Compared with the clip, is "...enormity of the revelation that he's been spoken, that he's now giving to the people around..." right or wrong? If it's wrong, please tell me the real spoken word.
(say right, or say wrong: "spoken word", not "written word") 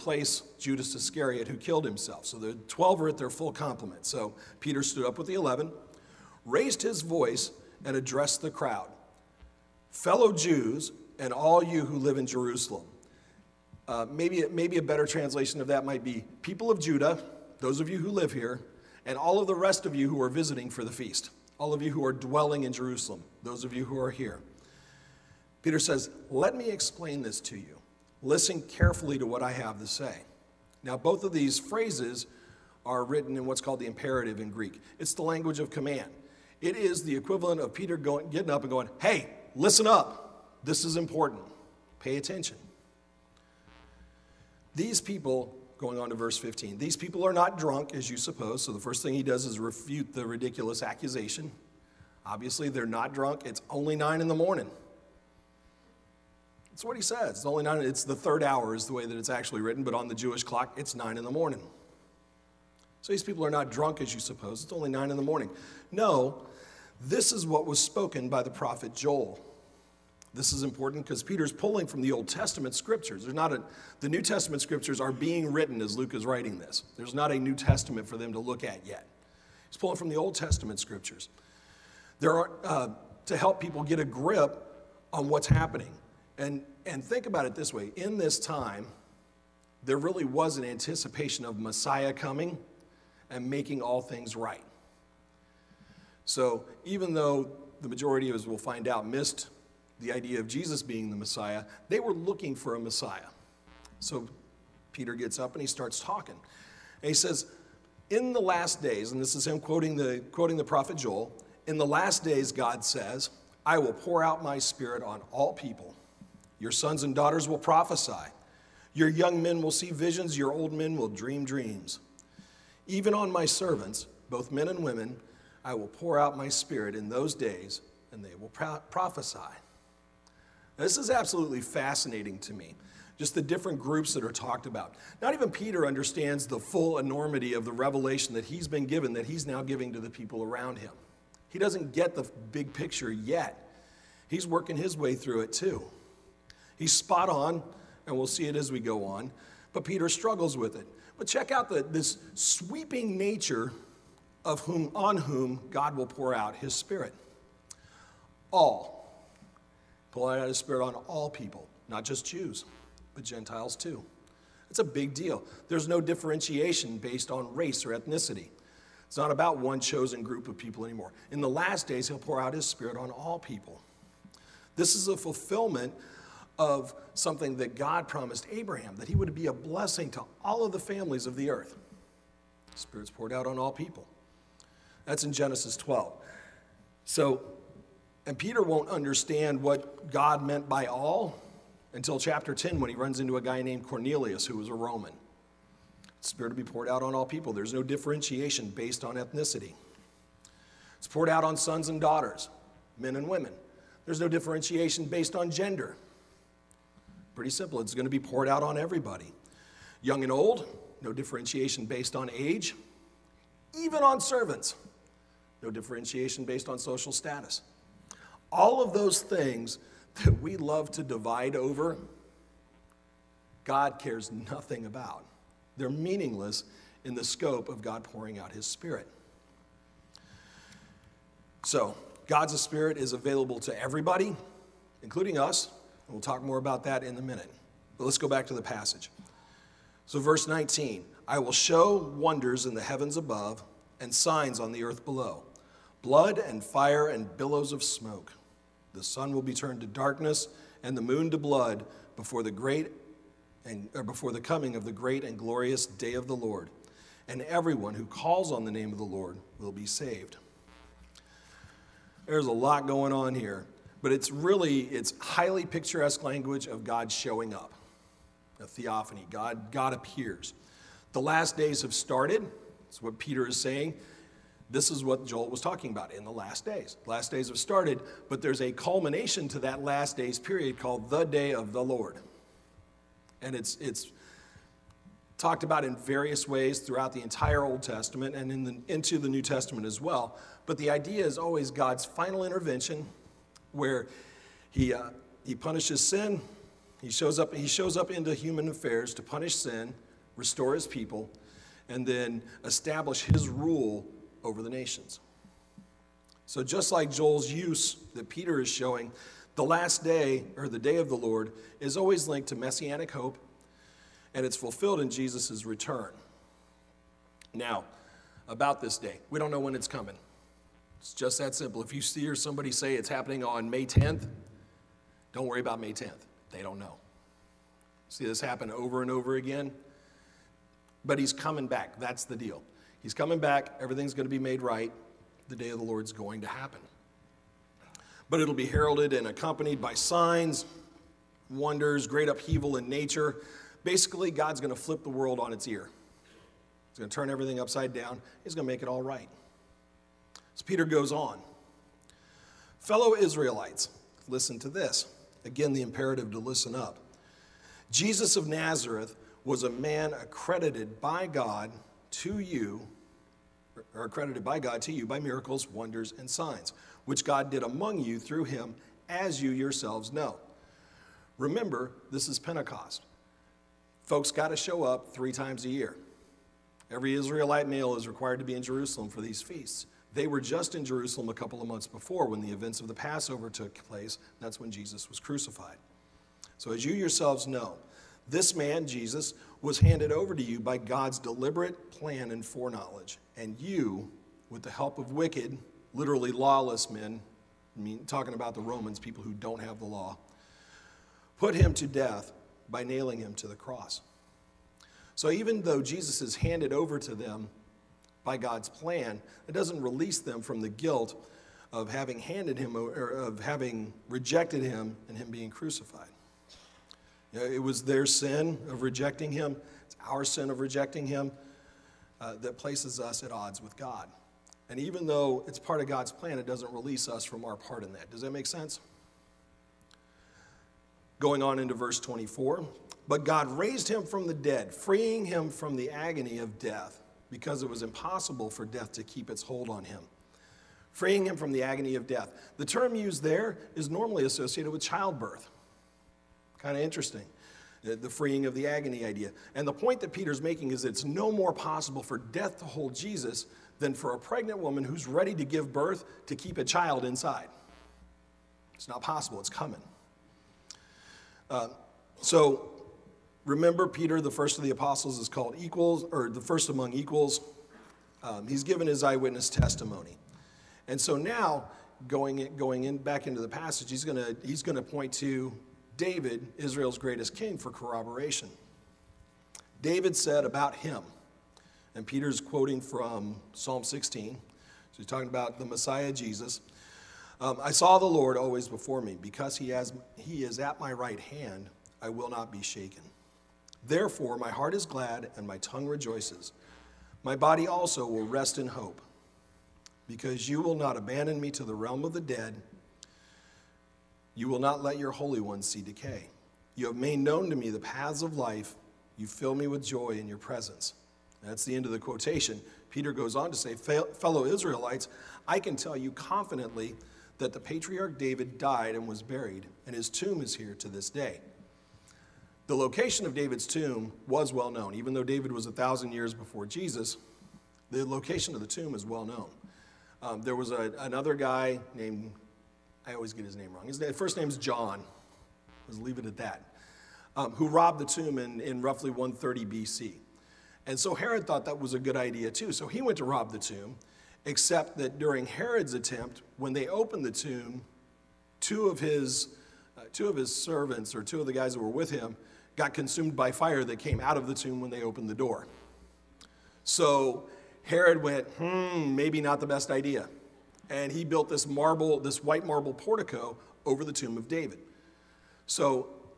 wrong: "given", not "spoken".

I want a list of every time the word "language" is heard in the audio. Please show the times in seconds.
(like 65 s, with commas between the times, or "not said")
35 s, 266 s.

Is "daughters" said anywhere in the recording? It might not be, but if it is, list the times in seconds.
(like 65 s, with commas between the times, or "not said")
117 s, 201 s.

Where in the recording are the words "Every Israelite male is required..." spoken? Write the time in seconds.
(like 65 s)
376 s.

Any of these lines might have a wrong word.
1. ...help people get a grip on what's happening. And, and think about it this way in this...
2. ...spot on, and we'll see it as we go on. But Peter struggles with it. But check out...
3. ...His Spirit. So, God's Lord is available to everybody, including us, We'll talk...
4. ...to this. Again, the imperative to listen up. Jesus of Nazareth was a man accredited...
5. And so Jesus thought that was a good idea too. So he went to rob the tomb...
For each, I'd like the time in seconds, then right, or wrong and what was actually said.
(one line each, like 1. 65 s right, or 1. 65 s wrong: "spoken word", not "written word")
1. 83 s right
2. 146 s right
3. 228 s wrong: "Spirit", not "Lord"
4. 354 s right
5. 540 s wrong: "Herod", not "Jesus".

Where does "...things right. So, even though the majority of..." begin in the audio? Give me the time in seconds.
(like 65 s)
94 s.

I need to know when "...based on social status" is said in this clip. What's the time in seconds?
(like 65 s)
216 s.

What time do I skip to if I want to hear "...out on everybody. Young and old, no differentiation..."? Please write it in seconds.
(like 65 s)
208 s.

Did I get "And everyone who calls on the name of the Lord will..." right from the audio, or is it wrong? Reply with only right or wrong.
right.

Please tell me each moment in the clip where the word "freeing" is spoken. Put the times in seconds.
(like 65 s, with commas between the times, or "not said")
434 s, 440 s, 448 s.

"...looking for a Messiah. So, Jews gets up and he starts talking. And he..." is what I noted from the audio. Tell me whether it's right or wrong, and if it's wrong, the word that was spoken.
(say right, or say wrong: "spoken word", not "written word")
wrong: "Peter", not "Jews".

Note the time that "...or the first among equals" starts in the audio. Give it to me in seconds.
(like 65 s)
466 s.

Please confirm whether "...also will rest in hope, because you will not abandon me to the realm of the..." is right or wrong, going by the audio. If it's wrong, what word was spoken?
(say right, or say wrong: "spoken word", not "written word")
right.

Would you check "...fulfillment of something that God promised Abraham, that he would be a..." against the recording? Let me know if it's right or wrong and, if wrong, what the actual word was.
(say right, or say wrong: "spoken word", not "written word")
right.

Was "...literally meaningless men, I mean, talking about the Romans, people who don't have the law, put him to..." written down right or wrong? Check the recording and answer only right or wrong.
wrong.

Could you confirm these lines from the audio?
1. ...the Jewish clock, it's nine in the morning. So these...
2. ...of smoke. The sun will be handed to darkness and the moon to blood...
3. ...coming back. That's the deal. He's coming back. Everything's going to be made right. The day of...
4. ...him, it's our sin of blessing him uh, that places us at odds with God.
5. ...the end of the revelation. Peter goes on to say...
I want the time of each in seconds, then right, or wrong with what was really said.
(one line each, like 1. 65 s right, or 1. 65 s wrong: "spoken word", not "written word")
1. 60 s right
2. 247 s wrong: "turned", not "handed"
3. 331 s right
4. 419 s wrong: "rejecting", not "blessing"
5. 511 s wrong: "quotation", not "revelation".